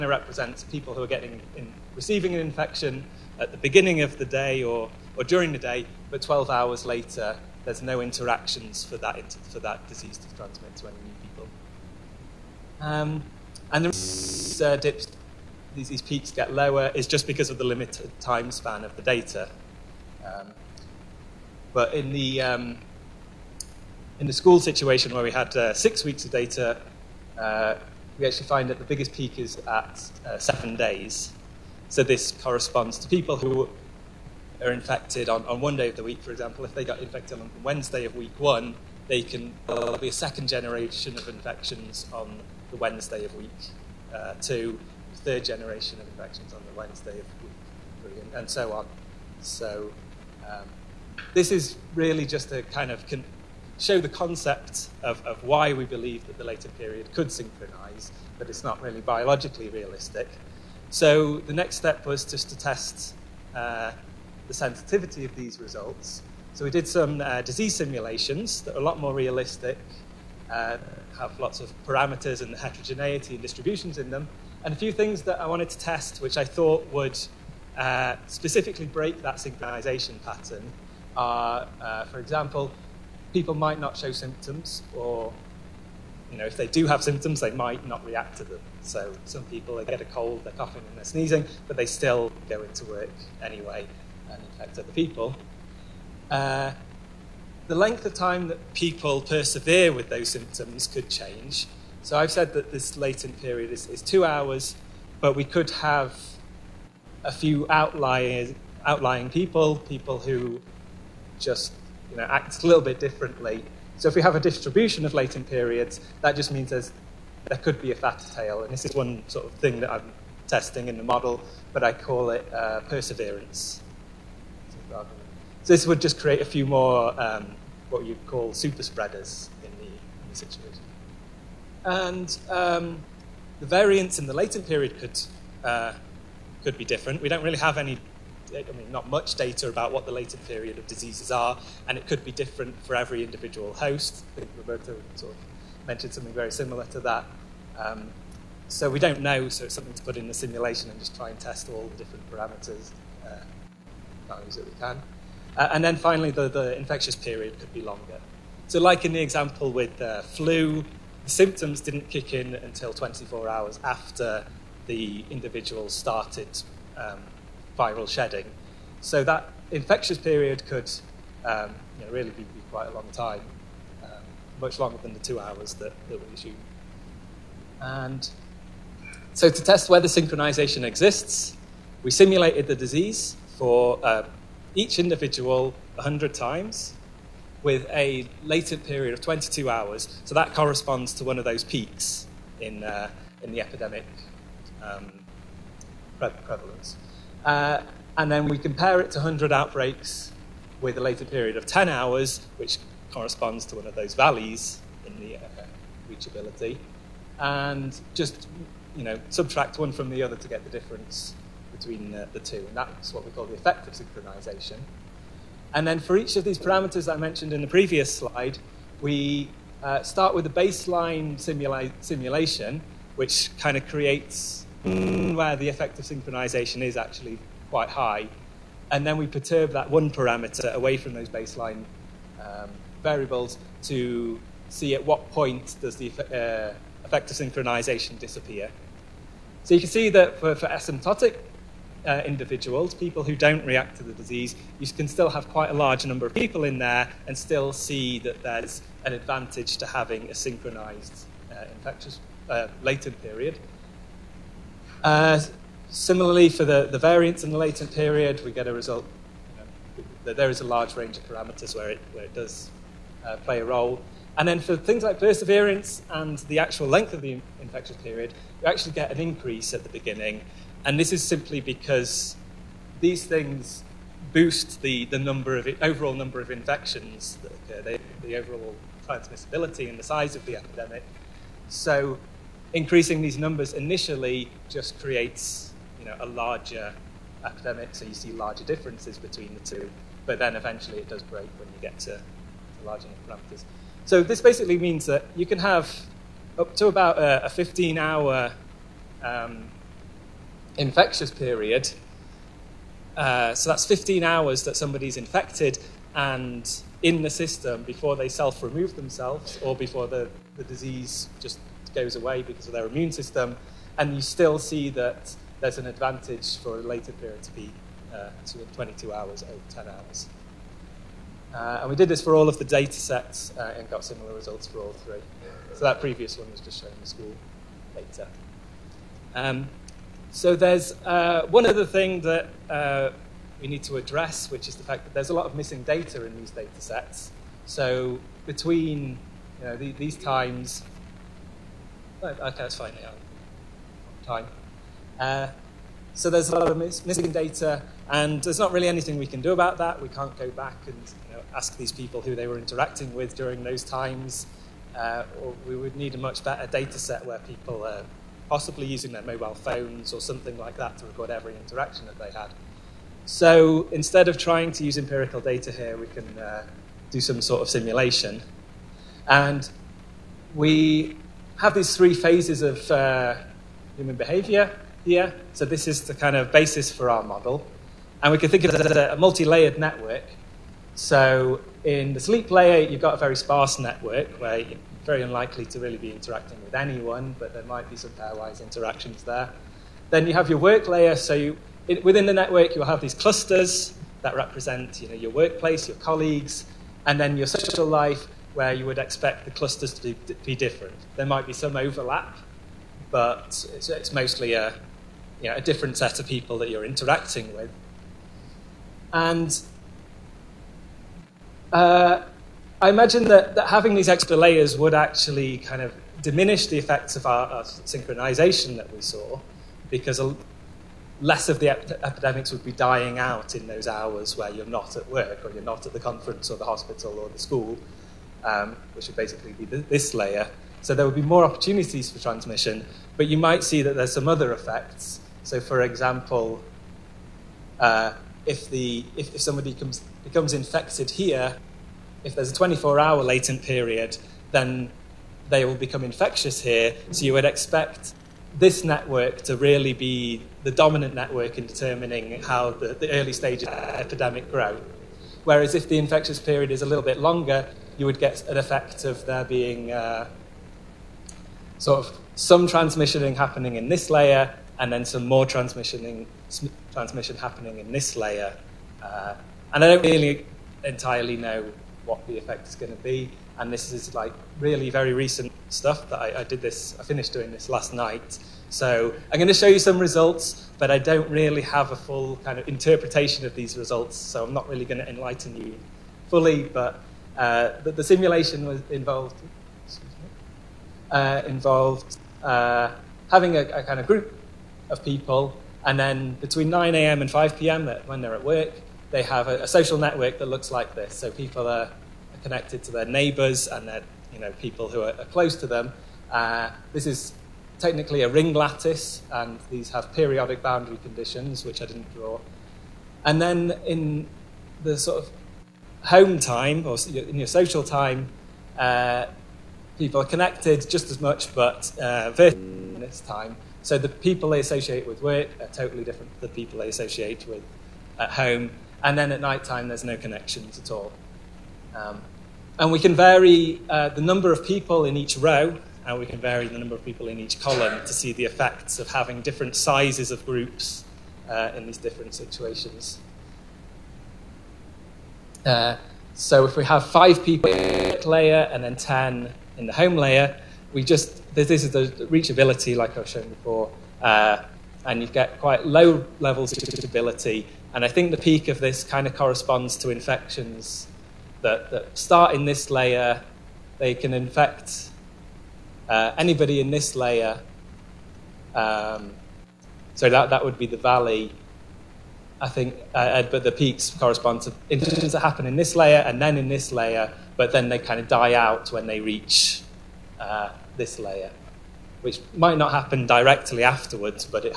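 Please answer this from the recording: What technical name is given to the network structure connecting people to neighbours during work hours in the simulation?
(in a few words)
ring lattice.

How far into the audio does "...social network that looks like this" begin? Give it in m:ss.
8:19.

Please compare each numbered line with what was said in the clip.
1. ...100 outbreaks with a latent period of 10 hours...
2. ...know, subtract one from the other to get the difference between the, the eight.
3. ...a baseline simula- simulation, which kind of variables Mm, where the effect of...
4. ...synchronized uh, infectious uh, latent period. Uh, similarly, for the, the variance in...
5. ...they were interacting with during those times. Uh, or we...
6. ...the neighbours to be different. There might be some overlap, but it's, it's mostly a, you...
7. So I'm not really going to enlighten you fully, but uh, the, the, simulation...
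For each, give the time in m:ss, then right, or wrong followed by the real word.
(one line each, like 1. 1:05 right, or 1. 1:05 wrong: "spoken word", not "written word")
1. 3:19 right
2. 3:29 wrong: "two", not "eight"
3. 3:40 wrong: "creates", not "variables"
4. 4:10 right
5. 5:52 right
6. 6:39 wrong: "clusters", not "neighbours"
7. 8:04 right.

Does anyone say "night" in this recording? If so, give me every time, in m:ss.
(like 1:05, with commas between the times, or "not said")
7:57, 8:49.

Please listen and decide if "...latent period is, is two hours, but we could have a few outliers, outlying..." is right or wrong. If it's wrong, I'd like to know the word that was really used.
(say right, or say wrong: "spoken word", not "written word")
right.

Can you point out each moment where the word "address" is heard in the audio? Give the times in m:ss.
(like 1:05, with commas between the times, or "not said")
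5:33.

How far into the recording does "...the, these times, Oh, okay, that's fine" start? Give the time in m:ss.
5:39.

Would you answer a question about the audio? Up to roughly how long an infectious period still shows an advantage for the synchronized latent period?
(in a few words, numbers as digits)
15 hours.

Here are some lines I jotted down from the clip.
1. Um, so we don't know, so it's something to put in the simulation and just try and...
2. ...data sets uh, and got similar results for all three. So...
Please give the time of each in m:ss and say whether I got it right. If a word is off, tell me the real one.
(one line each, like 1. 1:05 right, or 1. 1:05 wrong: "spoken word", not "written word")
1. 2:27 right
2. 5:22 right.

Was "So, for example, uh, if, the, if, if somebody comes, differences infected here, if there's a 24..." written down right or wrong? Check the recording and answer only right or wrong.
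wrong.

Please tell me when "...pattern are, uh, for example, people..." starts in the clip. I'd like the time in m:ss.
1:20.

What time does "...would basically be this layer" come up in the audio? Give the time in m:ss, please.
7:09.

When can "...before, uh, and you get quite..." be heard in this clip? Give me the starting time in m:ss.
9:13.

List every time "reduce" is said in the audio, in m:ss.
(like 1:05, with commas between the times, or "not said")
not said.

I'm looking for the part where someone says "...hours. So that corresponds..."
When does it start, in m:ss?
3:09.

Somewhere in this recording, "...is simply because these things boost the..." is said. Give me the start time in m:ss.
4:31.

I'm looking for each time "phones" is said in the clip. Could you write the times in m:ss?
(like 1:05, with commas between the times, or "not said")
5:59.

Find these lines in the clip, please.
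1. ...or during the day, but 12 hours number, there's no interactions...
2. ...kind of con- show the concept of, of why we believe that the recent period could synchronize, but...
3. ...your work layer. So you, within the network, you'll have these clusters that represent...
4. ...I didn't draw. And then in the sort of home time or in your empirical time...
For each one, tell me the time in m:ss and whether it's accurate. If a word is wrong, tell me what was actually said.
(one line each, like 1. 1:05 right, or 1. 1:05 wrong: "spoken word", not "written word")
1. 0:05 wrong: "later", not "number"
2. 0:52 wrong: "latent", not "recent"
3. 6:30 right
4. 8:31 wrong: "social", not "empirical".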